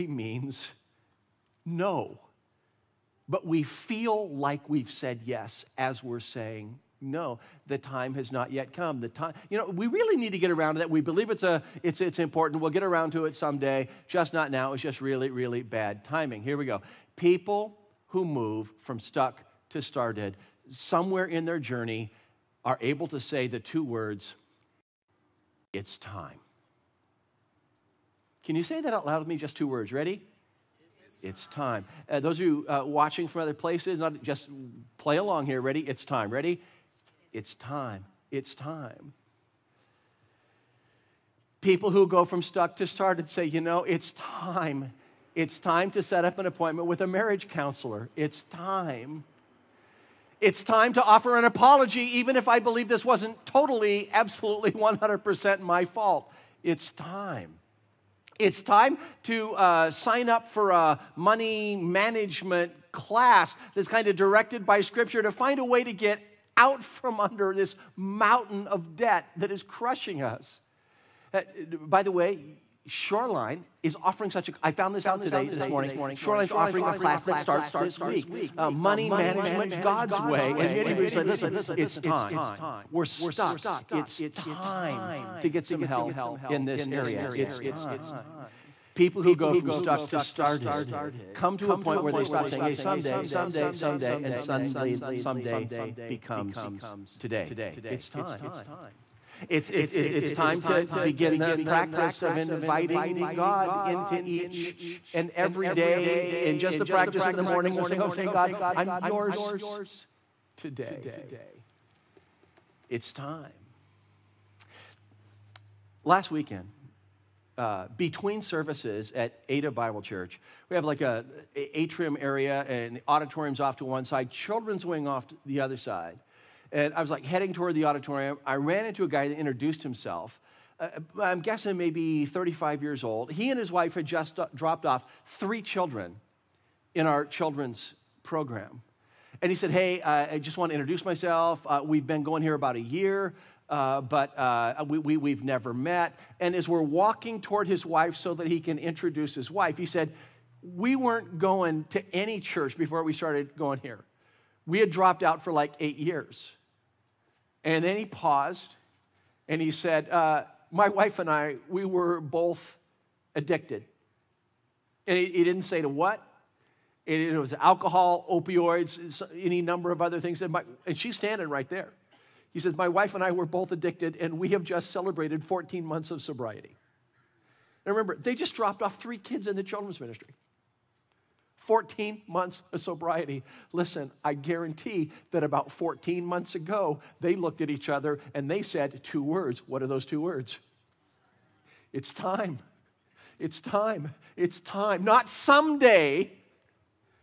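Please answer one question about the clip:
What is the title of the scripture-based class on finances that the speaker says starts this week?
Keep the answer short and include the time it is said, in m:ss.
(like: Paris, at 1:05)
Money Management God's Way, at 1:18.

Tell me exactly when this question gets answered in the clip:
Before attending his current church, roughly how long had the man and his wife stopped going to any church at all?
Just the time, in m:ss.
2:35.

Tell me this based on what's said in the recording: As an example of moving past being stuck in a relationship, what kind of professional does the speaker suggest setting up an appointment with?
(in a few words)
Marriage counselor.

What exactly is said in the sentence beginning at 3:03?
Listen, I guarantee that about 14 months ago, they looked at each other and they said two words.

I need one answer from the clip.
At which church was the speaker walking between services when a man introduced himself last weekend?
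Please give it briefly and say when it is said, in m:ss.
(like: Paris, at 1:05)
Ada Bible Church, at 1:59.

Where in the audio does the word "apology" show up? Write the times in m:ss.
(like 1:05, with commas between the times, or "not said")
0:51.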